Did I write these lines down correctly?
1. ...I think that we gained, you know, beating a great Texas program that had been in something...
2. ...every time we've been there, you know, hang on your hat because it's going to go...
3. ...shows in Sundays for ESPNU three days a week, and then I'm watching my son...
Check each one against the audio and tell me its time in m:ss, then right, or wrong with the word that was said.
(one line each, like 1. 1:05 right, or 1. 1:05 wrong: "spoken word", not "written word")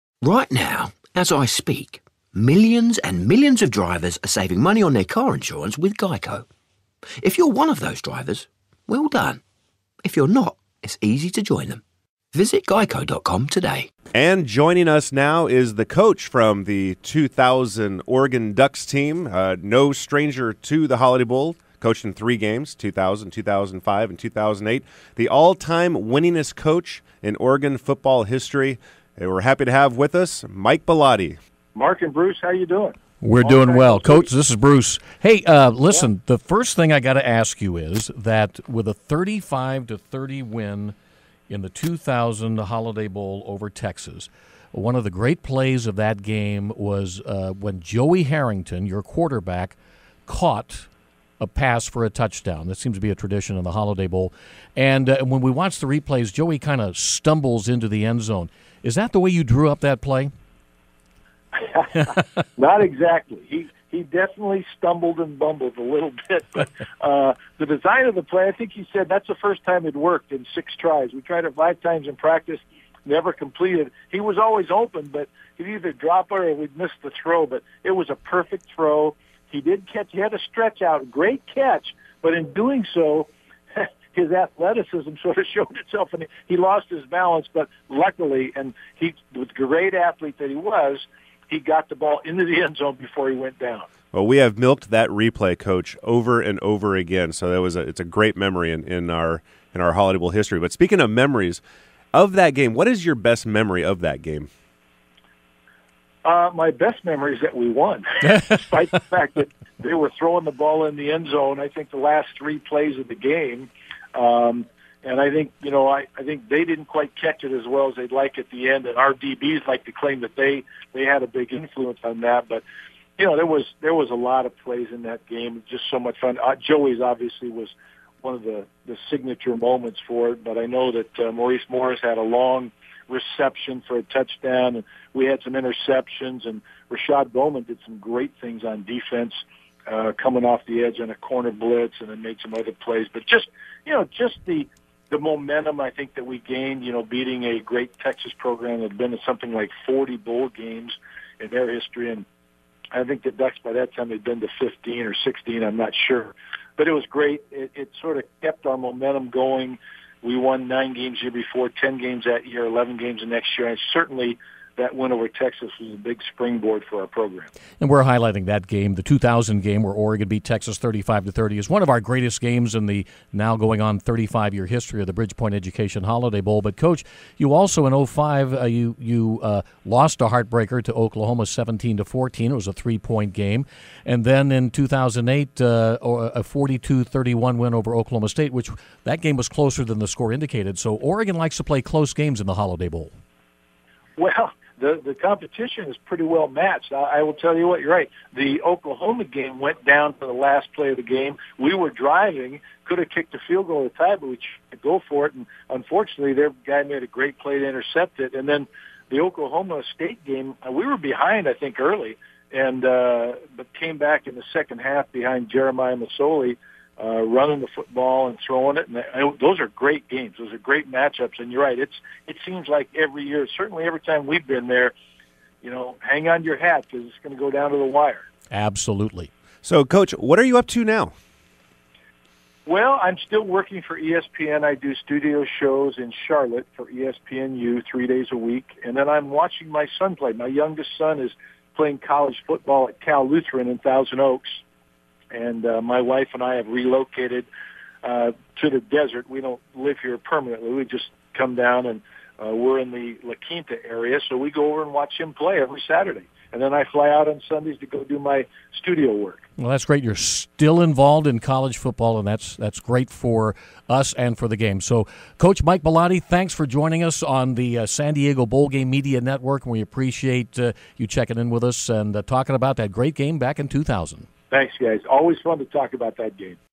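1. 2:25 right
2. 3:43 right
3. 3:55 wrong: "Charlotte", not "Sundays".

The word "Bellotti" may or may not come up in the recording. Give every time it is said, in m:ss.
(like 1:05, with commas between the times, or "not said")
0:30, 4:25.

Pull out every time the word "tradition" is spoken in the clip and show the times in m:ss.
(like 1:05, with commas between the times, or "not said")
0:53.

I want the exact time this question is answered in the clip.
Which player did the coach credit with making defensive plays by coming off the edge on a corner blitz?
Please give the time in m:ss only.
2:16.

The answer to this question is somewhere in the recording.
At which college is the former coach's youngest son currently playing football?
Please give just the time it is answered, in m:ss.
4:03.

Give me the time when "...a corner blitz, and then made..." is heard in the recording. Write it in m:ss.
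2:21.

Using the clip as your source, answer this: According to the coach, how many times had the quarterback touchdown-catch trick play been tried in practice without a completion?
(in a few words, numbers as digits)
5.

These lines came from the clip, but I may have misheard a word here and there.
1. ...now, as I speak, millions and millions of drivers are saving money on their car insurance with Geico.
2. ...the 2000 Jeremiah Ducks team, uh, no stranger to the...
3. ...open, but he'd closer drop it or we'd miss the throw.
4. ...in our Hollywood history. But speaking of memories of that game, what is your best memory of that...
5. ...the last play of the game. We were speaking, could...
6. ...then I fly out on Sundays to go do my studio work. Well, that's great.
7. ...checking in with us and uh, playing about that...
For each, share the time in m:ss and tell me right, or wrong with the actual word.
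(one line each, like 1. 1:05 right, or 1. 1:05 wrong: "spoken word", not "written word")
1. 0:00 right
2. 0:16 wrong: "Oregon", not "Jeremiah"
3. 1:14 wrong: "either", not "closer"
4. 1:39 right
5. 3:20 wrong: "driving", not "speaking"
6. 4:16 right
7. 4:31 wrong: "talking", not "playing".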